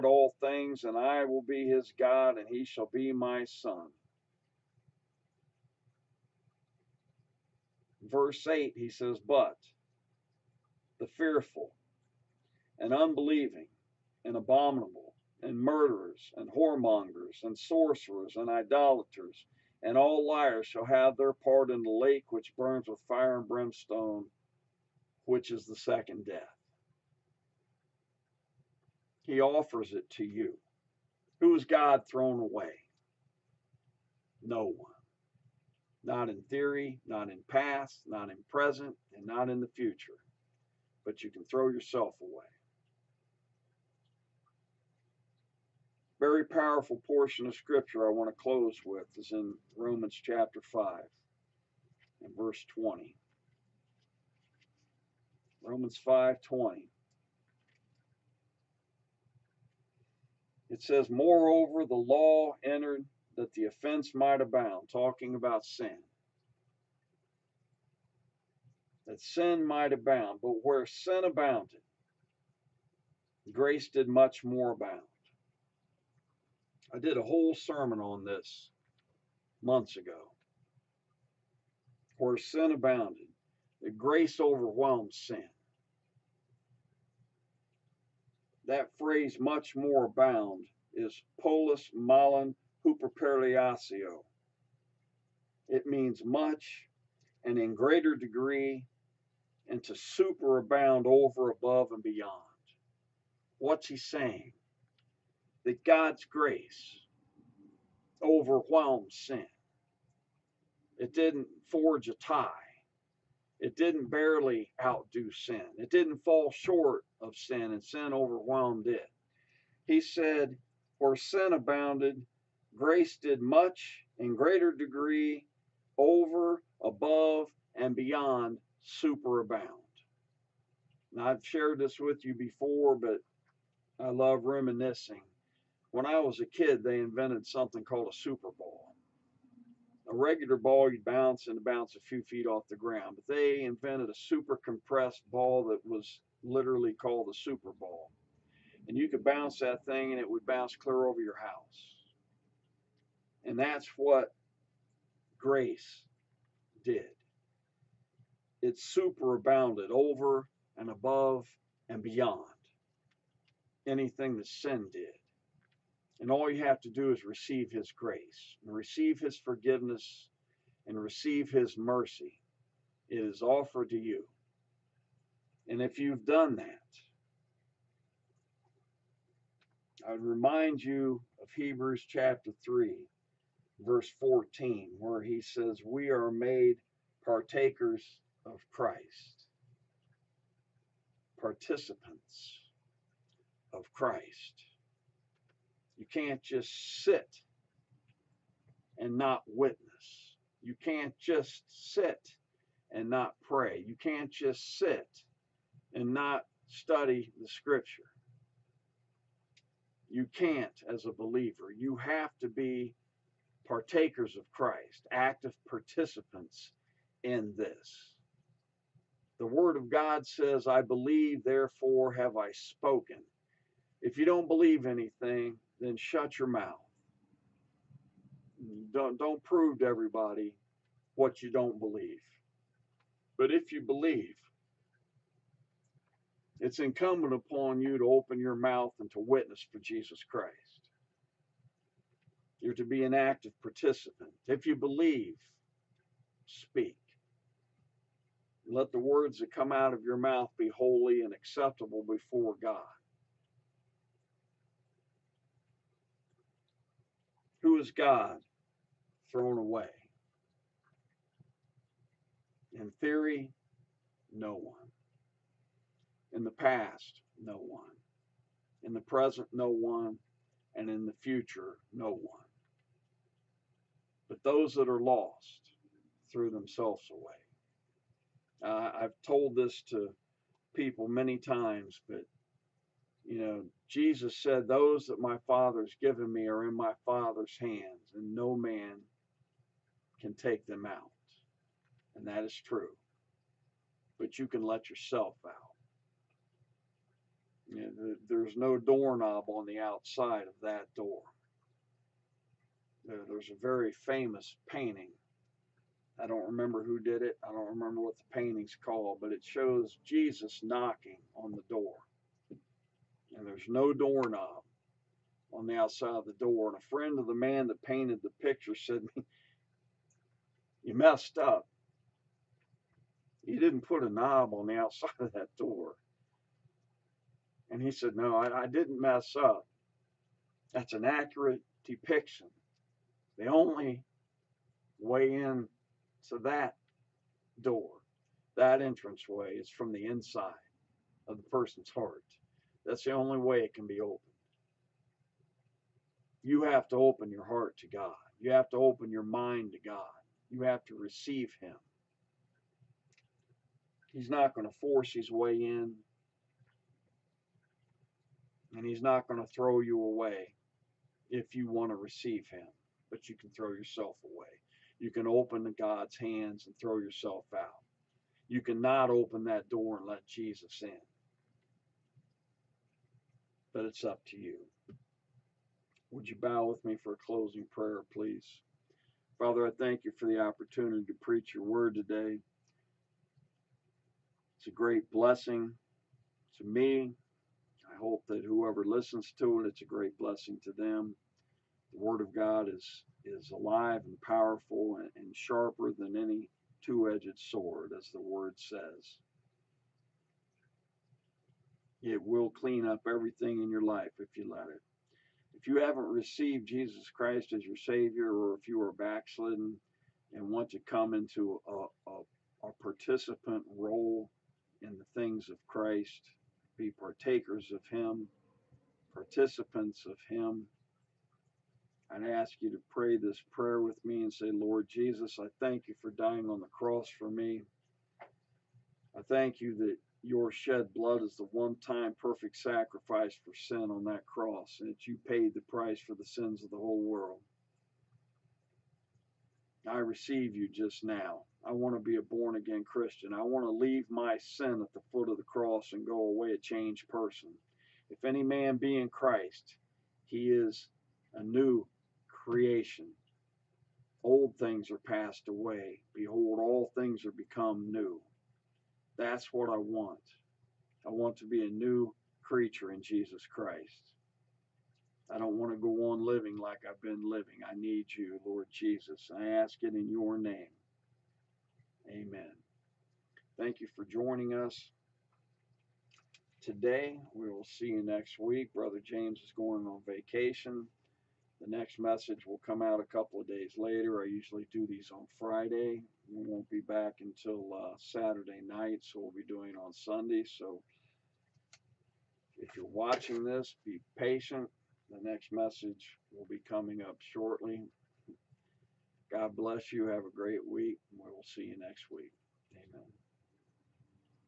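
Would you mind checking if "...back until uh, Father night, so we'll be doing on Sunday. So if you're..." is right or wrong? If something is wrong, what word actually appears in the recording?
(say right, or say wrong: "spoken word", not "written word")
wrong: "Saturday", not "Father".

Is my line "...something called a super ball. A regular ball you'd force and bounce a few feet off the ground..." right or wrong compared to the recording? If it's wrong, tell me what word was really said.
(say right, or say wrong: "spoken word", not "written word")
wrong: "bounce", not "force".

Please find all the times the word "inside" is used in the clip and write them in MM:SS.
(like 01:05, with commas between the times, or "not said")
05:40.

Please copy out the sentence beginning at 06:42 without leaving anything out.
It will clean up everything in your life if you let it.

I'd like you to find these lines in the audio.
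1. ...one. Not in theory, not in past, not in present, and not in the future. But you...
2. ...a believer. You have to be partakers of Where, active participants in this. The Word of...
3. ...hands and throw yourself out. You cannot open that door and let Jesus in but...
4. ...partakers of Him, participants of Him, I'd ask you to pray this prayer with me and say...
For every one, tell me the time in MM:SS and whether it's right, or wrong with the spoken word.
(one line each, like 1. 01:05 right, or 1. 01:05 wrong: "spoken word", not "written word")
1. 00:34 right
2. 03:31 wrong: "Christ", not "Where"
3. 06:06 right
4. 06:56 right.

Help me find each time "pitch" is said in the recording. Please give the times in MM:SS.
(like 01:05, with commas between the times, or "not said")
not said.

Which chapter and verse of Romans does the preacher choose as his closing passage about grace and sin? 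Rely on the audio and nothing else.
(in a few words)
Romans 5:20.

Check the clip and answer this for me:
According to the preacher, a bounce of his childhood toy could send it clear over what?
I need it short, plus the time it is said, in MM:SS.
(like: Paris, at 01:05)
your house, at 02:31.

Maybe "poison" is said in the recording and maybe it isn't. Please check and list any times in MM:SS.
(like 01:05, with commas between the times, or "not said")
not said.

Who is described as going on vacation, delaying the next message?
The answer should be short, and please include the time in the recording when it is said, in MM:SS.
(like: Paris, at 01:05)
Brother James, at 07:58.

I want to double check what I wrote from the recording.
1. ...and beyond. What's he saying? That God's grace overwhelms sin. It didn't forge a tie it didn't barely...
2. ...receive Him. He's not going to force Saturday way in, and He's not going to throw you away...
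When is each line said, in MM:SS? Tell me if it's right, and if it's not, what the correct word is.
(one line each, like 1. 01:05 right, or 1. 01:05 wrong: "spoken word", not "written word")
1. 01:41 right
2. 05:50 wrong: "His", not "Saturday".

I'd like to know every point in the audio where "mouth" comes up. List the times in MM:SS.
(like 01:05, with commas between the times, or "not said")
03:46, 03:58, 04:10.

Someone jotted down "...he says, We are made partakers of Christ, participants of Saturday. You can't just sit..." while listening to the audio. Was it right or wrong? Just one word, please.
wrong.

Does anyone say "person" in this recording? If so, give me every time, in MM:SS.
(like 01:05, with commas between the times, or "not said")
05:41, 07:27.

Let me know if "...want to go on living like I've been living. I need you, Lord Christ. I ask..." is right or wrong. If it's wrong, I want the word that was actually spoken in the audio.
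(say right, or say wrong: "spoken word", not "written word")
wrong: "Jesus", not "Christ".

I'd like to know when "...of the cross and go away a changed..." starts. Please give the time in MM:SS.
07:25.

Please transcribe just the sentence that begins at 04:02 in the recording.
You're to be an active participant.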